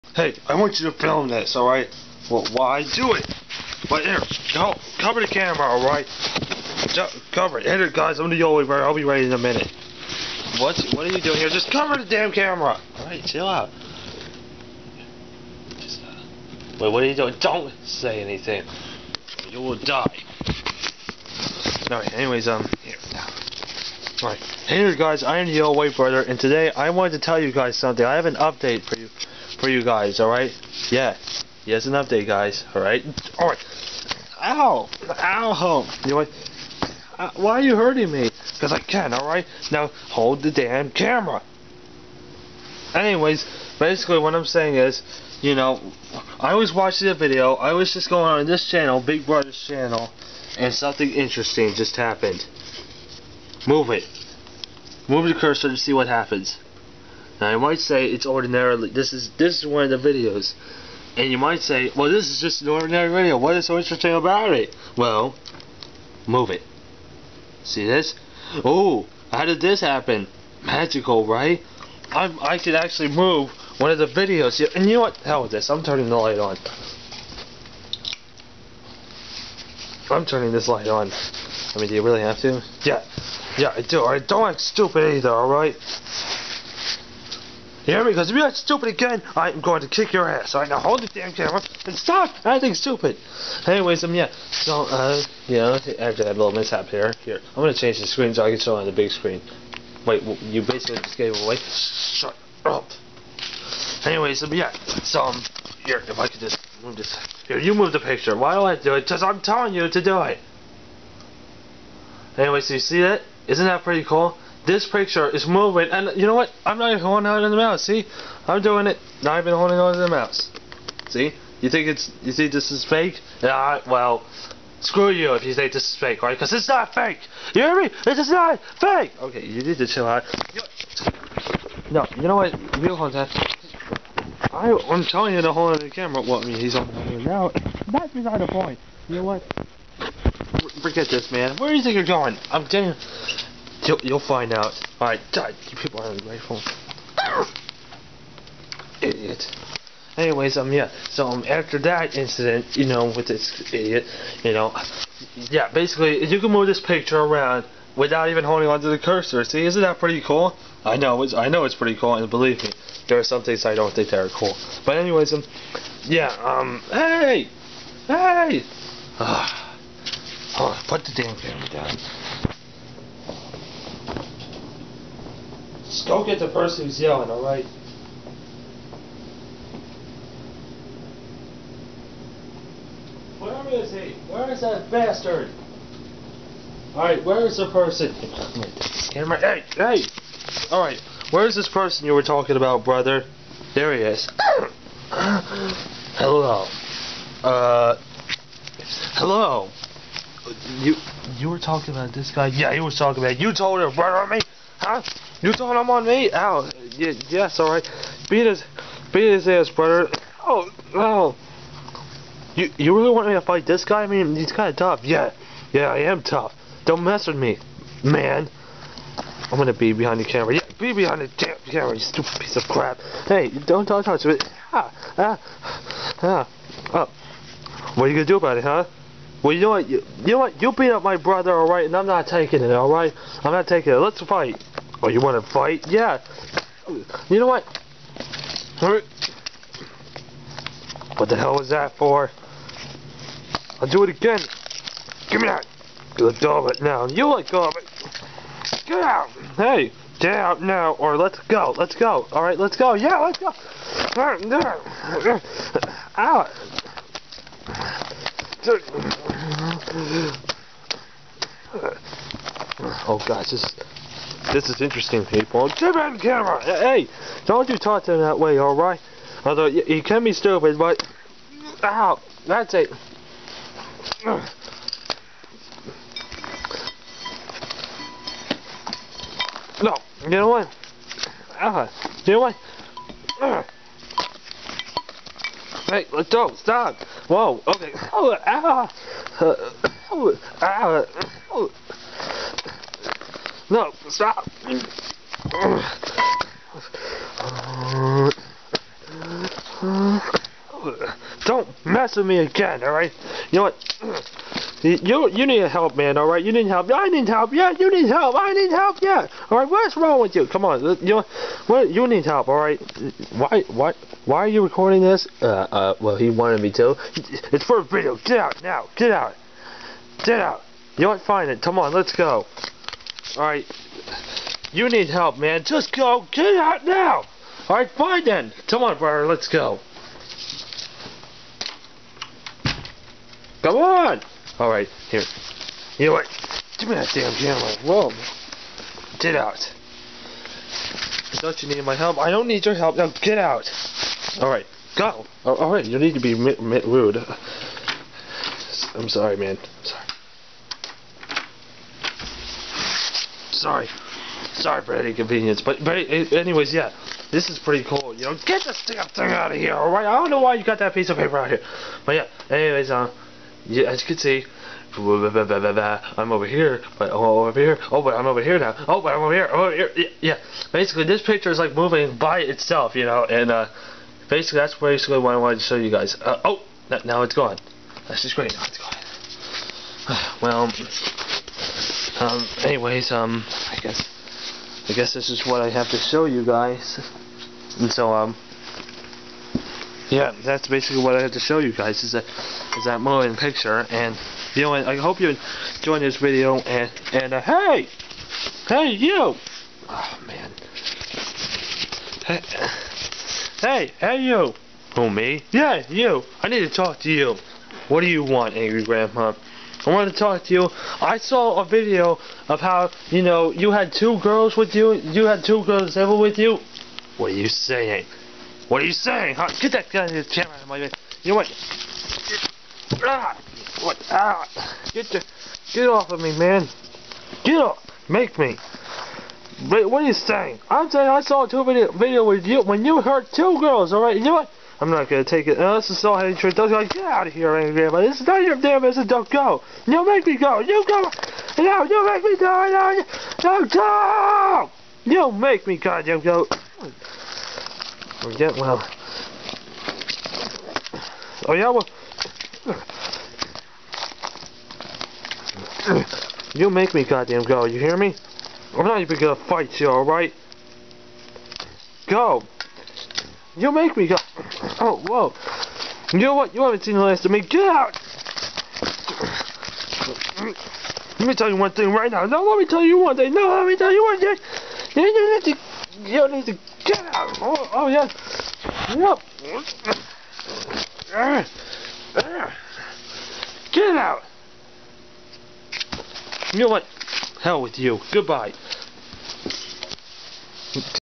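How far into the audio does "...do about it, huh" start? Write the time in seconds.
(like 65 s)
228 s.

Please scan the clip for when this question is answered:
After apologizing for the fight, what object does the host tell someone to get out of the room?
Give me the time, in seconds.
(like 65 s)
360 s.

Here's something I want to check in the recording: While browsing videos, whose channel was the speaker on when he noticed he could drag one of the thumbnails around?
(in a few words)
Big Brother's channel.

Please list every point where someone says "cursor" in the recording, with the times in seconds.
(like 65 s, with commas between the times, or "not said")
55 s, 158 s.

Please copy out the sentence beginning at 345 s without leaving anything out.
Oh, Alright, you need to be rude.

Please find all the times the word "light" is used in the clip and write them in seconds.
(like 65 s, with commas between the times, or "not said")
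76 s, 80 s.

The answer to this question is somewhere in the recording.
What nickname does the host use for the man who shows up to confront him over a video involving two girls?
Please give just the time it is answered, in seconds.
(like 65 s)
408 s.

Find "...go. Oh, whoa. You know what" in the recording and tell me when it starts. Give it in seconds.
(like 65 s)
464 s.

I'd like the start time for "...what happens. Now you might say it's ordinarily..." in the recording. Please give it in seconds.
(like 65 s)
55 s.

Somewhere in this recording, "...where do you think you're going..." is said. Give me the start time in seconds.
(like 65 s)
141 s.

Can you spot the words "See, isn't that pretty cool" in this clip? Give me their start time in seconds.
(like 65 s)
159 s.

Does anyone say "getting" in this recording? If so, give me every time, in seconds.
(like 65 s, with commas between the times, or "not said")
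142 s, 448 s.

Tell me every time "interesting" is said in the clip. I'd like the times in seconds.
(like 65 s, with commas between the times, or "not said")
51 s, 63 s, 264 s.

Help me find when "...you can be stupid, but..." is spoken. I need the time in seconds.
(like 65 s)
269 s.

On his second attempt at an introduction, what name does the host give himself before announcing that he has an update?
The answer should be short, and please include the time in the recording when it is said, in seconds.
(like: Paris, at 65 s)
Yellow Weight Brother, at 25 s.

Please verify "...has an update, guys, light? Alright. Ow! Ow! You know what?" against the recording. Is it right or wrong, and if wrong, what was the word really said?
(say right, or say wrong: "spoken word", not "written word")
wrong: "alright", not "light".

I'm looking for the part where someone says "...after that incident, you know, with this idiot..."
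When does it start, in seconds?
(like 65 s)
151 s.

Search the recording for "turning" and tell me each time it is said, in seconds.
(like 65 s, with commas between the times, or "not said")
75 s, 80 s.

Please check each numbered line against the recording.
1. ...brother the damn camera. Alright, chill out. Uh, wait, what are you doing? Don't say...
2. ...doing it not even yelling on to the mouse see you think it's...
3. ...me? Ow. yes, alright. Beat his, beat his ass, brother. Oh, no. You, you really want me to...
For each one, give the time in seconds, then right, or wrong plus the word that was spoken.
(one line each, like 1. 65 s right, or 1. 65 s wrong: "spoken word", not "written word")
1. 11 s wrong: "cover", not "brother"
2. 118 s wrong: "holding", not "yelling"
3. 206 s right.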